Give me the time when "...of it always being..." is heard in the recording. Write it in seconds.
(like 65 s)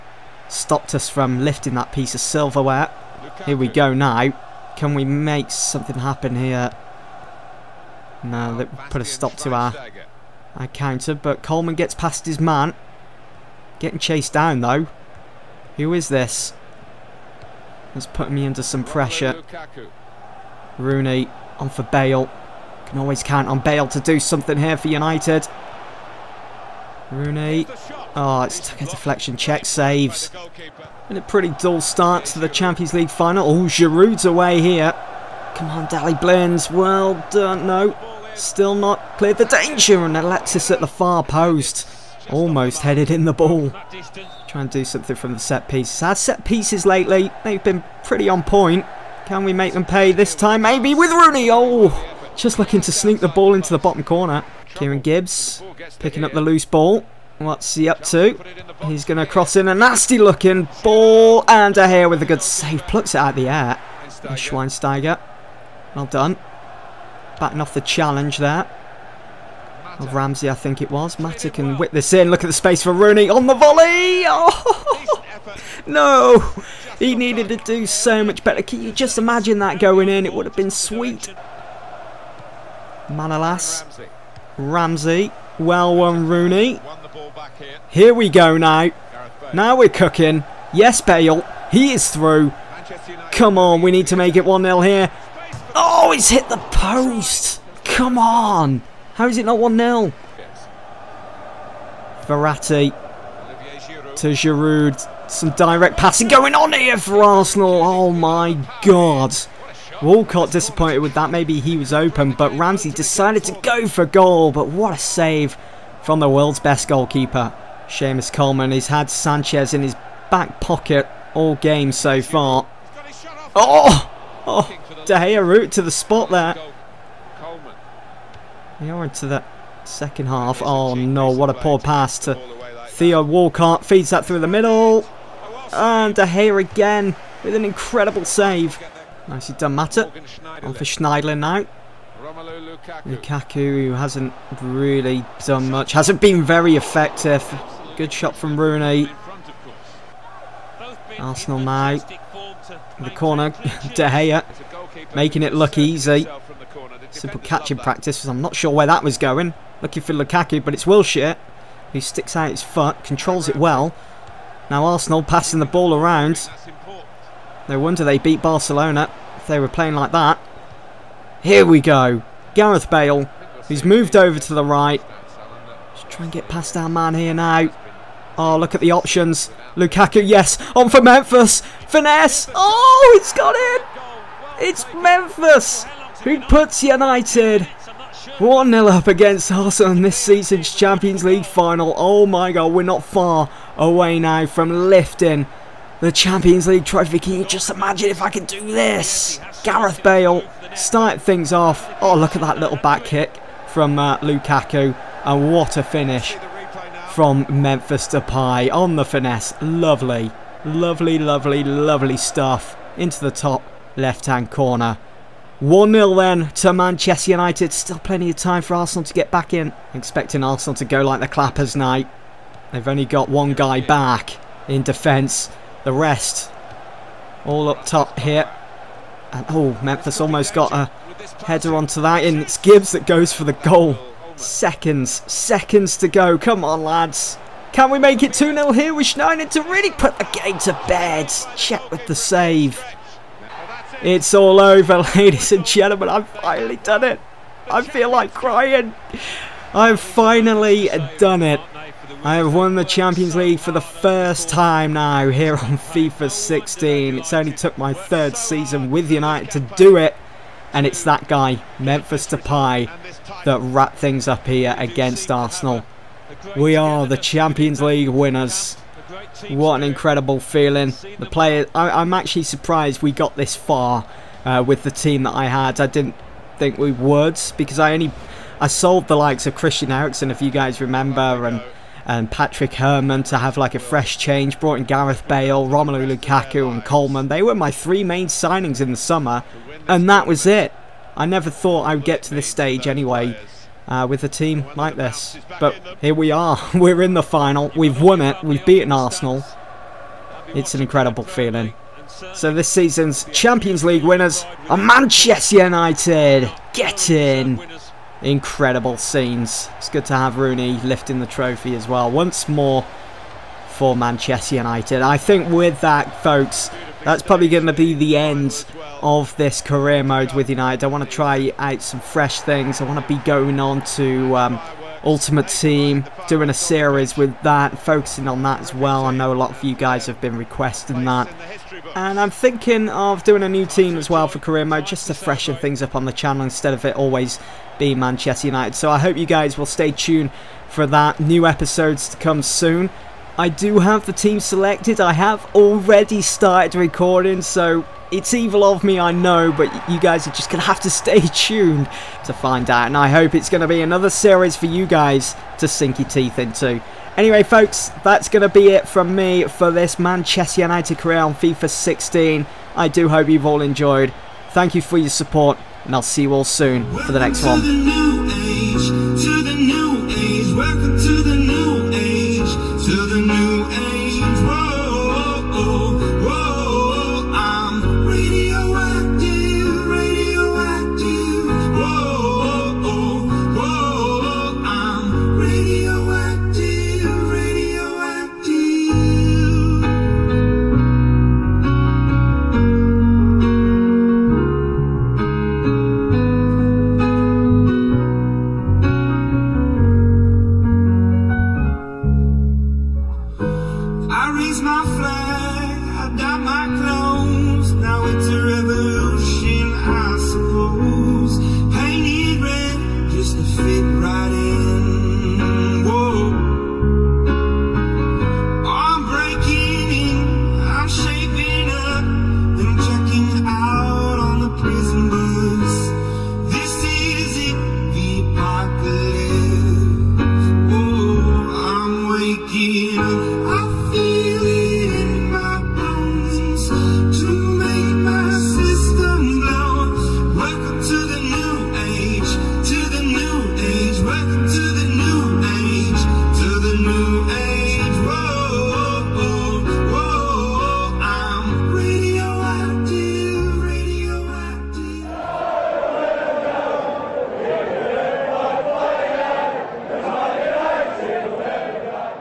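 336 s.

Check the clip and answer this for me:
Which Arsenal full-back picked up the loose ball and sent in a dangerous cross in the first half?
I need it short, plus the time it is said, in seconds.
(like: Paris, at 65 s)
Kieran Gibbs, at 54 s.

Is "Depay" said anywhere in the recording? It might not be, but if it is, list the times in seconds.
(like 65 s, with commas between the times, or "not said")
208 s, 262 s.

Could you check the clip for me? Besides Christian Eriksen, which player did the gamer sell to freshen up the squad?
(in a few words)
Patrick Herrmann.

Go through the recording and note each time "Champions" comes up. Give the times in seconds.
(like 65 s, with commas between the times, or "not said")
32 s, 190 s, 196 s, 252 s, 267 s, 303 s.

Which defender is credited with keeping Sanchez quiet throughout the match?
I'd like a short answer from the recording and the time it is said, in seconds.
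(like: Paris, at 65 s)
Seamus Coleman, at 117 s.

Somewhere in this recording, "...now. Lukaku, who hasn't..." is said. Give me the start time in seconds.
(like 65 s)
141 s.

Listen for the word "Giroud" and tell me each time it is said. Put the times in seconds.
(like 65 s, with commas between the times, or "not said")
33 s, 104 s.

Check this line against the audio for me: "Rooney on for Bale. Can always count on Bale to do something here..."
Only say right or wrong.
right.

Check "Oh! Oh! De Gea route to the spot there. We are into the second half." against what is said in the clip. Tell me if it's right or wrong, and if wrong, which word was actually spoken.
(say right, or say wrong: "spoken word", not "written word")
right.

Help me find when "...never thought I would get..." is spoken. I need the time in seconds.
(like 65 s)
291 s.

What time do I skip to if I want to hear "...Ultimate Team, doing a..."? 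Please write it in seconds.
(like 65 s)
325 s.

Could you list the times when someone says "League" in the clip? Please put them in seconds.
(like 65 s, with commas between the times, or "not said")
32 s, 191 s, 196 s, 253 s, 267 s, 303 s.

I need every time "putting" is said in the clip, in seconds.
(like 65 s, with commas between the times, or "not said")
18 s.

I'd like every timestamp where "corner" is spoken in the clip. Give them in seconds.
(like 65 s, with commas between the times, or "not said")
54 s, 153 s, 214 s.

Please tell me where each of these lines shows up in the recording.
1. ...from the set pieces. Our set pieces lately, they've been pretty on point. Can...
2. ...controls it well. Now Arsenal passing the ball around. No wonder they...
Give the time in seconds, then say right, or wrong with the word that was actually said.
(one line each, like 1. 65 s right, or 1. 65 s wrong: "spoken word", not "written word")
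1. 45 s right
2. 163 s right.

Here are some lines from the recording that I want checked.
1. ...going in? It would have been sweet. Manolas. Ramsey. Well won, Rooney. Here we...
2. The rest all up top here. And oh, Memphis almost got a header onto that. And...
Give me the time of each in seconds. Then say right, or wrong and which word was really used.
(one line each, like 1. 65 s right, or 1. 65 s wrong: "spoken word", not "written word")
1. 79 s right
2. 225 s right.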